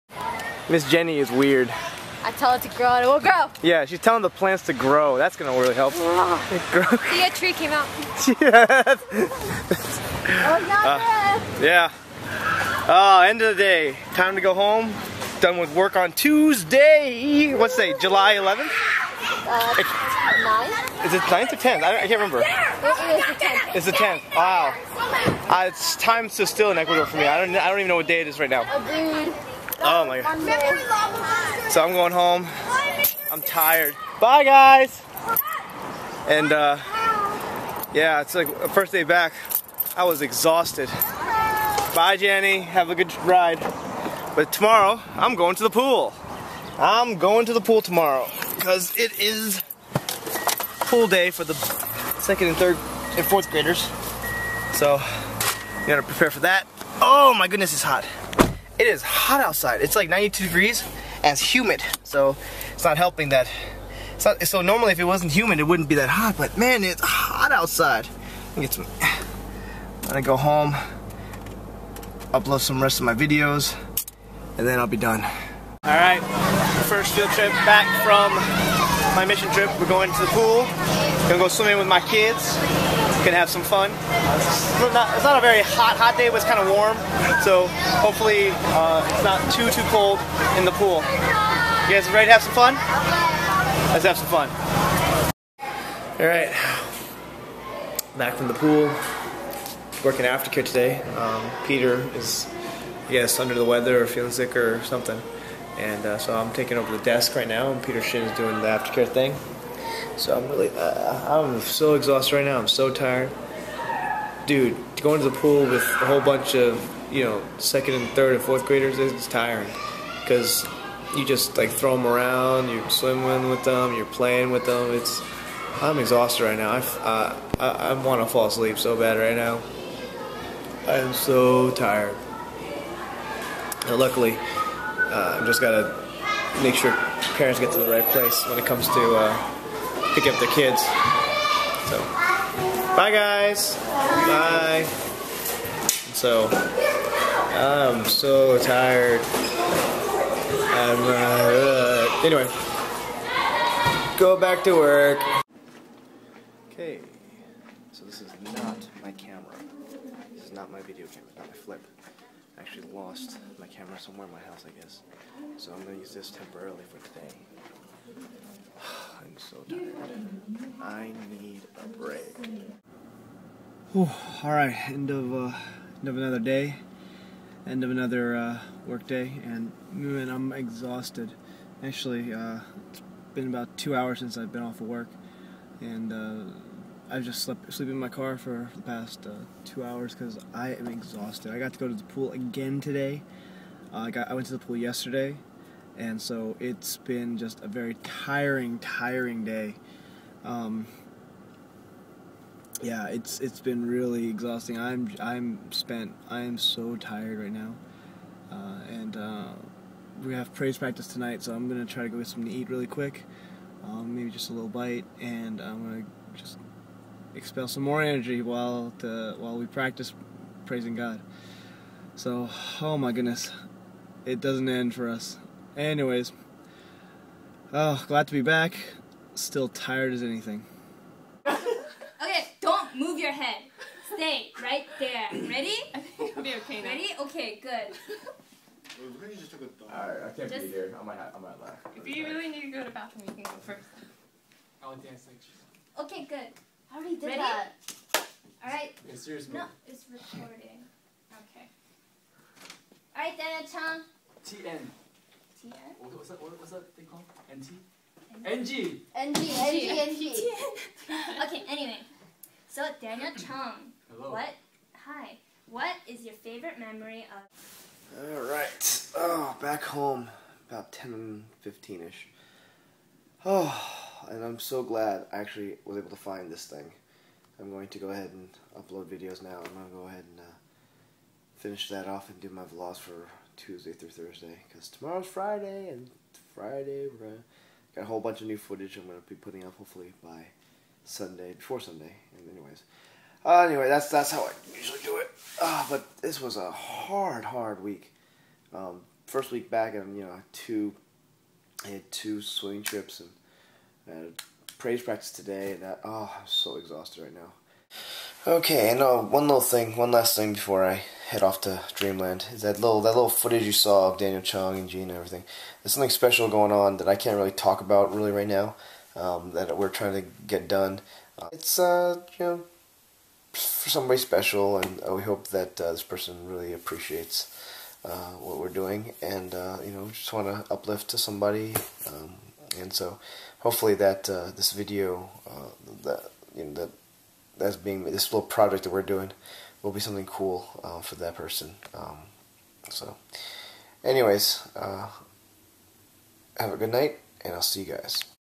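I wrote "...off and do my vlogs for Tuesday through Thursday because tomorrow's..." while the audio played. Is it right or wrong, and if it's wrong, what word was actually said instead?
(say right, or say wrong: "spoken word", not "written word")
right.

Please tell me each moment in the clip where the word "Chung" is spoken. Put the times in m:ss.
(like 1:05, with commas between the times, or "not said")
4:23, 5:14.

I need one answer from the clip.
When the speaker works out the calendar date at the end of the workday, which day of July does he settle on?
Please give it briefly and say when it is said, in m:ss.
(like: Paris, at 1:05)
10th, at 0:22.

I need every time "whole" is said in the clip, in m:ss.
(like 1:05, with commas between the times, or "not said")
1:56, 4:48.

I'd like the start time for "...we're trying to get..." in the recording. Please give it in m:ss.
5:19.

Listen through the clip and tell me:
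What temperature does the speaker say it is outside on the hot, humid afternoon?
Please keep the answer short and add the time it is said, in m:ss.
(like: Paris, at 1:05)
92 degrees, at 1:00.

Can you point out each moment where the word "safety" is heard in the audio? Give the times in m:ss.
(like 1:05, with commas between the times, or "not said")
not said.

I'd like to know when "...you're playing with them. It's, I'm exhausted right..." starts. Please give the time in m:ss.
2:03.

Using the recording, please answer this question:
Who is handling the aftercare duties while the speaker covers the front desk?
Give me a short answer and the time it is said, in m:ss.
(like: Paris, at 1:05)
Peter Shin, at 1:47.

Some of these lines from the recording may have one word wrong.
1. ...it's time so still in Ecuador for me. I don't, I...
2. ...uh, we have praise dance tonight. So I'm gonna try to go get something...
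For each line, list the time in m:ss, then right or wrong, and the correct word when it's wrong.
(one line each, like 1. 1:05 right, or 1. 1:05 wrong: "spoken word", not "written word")
1. 0:25 right
2. 3:29 wrong: "practice", not "dance".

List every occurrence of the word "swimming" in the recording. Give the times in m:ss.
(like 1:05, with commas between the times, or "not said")
1:21, 2:02, 5:02.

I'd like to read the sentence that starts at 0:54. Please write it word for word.
So, you gotta prepare for that.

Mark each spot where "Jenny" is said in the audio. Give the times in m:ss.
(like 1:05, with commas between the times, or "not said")
0:00, 0:42.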